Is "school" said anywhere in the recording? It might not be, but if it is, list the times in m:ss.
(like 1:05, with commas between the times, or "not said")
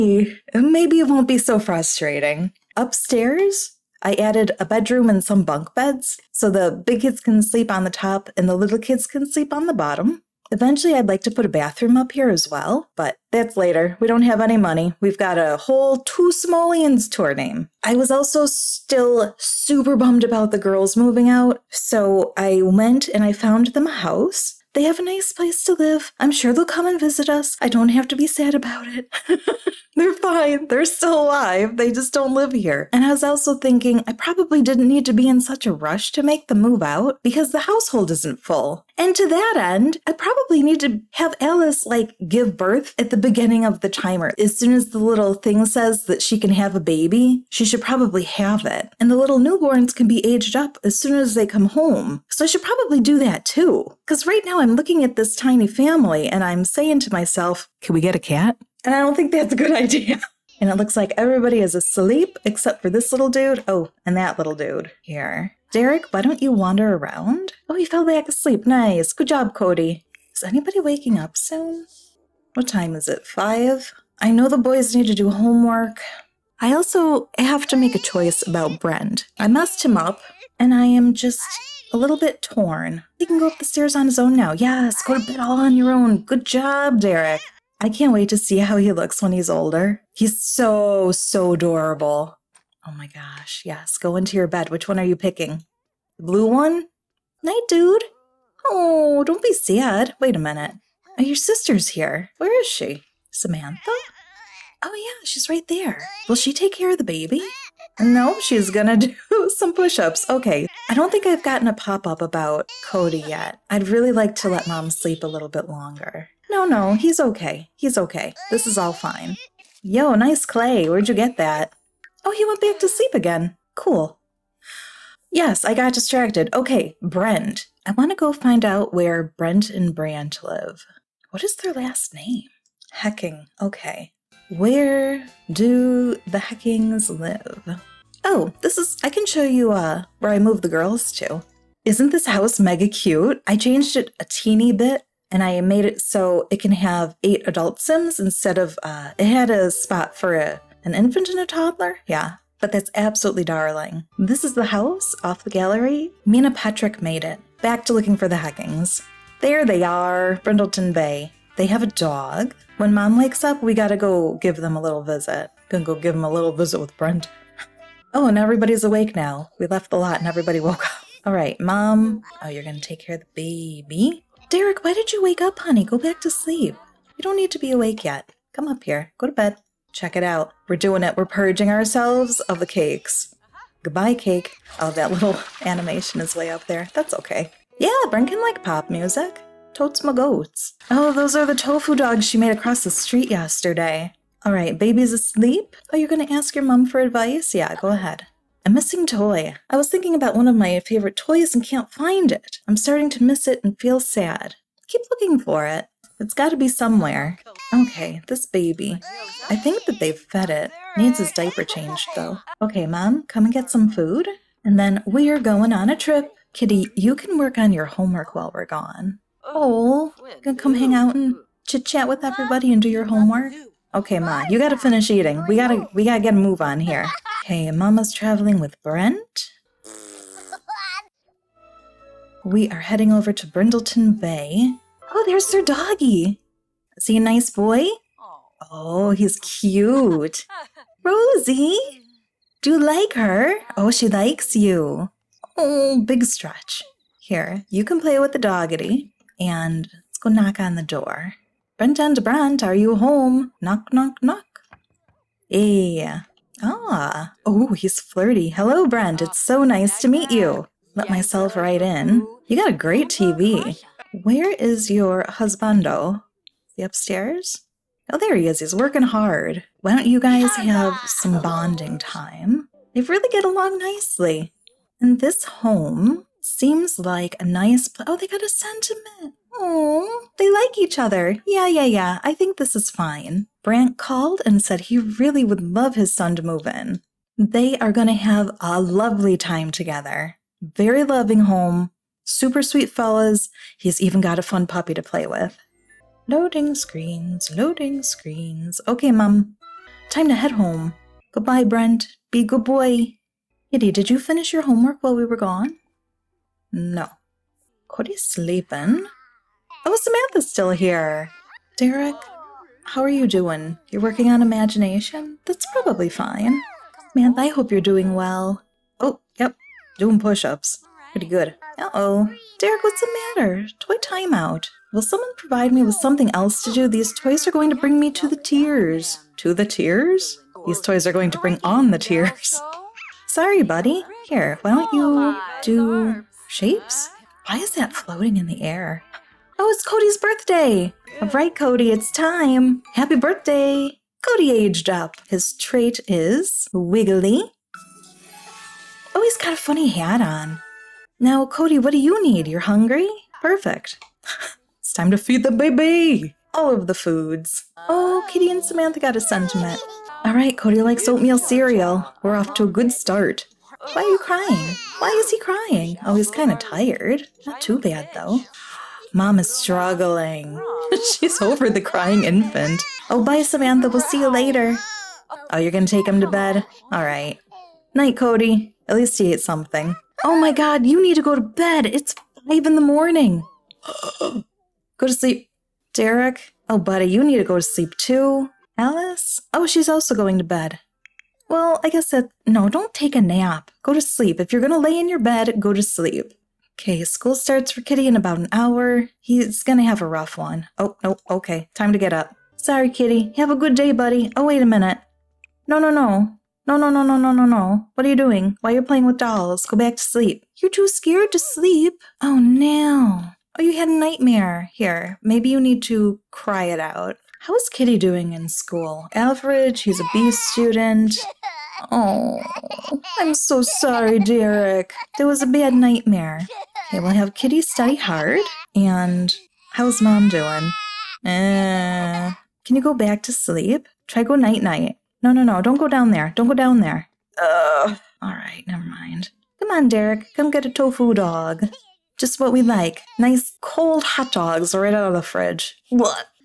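6:37, 6:58.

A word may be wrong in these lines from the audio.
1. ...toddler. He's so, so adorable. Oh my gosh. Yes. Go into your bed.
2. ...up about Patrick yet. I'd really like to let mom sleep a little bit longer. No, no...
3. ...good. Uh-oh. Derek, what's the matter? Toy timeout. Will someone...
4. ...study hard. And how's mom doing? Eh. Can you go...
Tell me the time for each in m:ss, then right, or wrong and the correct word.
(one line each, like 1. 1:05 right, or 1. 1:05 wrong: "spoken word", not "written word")
1. 1:29 wrong: "older", not "toddler"
2. 1:52 wrong: "Cody", not "Patrick"
3. 5:21 right
4. 7:07 right.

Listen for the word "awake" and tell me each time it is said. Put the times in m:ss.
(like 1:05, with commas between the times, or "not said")
2:48, 2:57.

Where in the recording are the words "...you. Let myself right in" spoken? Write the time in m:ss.
4:20.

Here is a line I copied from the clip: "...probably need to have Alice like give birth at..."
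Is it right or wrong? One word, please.
right.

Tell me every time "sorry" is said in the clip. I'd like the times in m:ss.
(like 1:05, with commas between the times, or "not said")
5:33, 6:42, 7:03.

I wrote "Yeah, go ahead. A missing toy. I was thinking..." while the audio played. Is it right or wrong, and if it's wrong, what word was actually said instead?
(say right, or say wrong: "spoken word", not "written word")
right.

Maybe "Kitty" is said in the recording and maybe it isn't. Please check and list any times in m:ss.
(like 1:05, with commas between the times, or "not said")
3:36, 5:03, 5:58, 6:37, 6:42, 6:57, 7:07.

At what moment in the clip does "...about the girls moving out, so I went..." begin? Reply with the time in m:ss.
0:20.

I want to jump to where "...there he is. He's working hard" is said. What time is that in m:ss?
4:28.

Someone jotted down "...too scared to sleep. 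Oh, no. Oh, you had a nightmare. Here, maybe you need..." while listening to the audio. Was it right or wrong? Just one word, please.
right.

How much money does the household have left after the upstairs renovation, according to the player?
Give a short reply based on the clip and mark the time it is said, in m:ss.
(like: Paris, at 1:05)
2 Simoleons, at 0:15.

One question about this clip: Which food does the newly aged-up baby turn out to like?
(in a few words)
Oatmeal cereal.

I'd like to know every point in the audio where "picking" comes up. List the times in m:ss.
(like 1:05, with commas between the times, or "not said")
1:35.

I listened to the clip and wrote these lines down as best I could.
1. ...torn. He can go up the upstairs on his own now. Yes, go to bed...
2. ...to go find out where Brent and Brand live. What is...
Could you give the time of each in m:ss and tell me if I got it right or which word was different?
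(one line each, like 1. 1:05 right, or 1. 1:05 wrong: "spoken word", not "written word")
1. 1:22 wrong: "stairs", not "upstairs"
2. 2:08 right.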